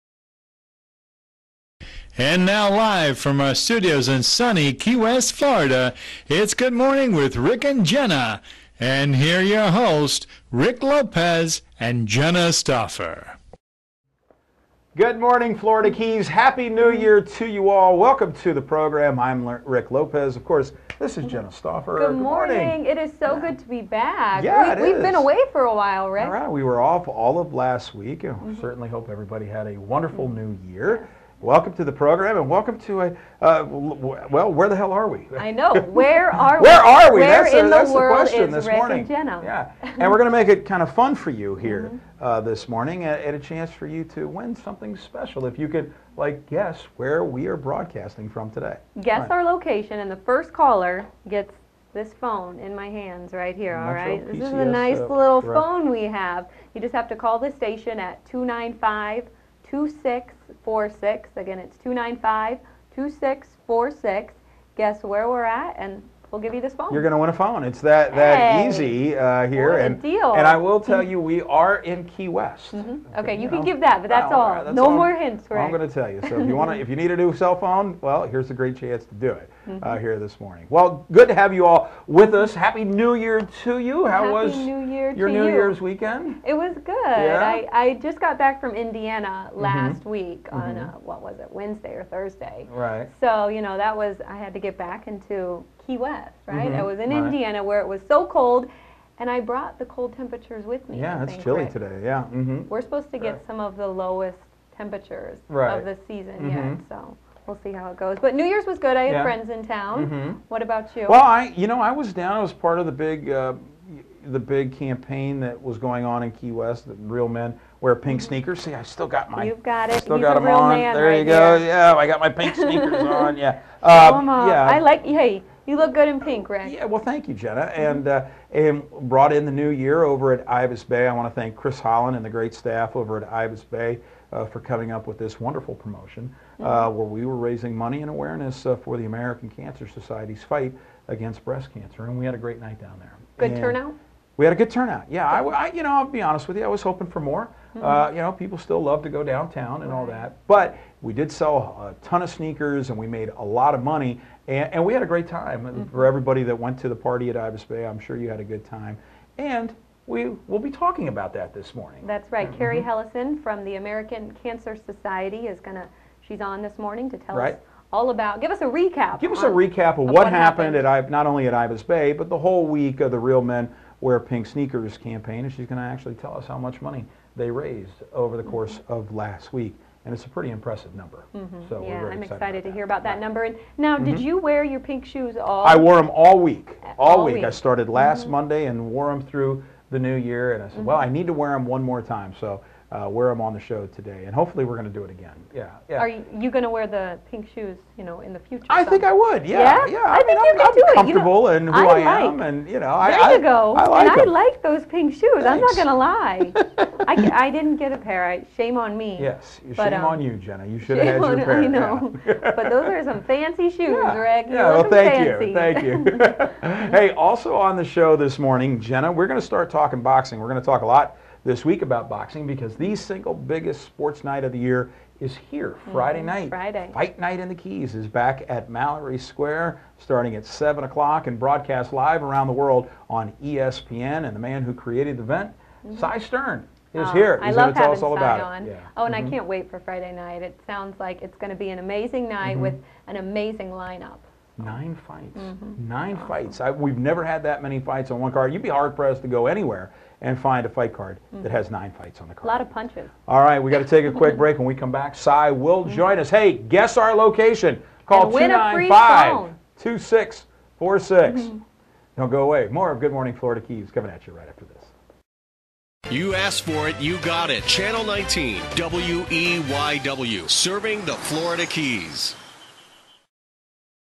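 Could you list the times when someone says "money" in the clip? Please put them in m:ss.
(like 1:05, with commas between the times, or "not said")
2:17, 2:33, 2:56.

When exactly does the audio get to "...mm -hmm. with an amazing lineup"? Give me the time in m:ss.
4:02.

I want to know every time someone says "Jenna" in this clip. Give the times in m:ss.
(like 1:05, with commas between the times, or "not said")
0:07, 0:12, 0:21, 0:39, 2:07, 3:30, 3:38.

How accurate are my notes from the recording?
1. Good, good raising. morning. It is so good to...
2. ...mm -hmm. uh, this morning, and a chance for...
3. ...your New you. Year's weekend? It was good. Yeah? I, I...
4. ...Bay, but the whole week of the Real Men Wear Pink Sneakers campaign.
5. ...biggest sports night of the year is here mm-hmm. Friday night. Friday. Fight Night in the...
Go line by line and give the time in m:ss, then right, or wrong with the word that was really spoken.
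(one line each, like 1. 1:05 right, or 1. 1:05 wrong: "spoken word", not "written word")
1. 0:21 wrong: "morning", not "raising"
2. 0:41 right
3. 1:25 right
4. 2:51 right
5. 3:43 right.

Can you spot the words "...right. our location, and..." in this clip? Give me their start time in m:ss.
0:49.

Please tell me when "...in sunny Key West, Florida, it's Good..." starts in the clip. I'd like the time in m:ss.
0:04.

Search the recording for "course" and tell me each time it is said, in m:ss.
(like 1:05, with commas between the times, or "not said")
0:20, 2:58.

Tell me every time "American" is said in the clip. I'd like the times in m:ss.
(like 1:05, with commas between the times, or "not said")
2:19, 2:43.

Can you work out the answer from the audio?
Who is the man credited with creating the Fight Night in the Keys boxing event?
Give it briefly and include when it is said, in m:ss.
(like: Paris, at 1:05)
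Cy Stern, at 3:56.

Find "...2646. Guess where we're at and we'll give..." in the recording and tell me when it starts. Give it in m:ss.
1:02.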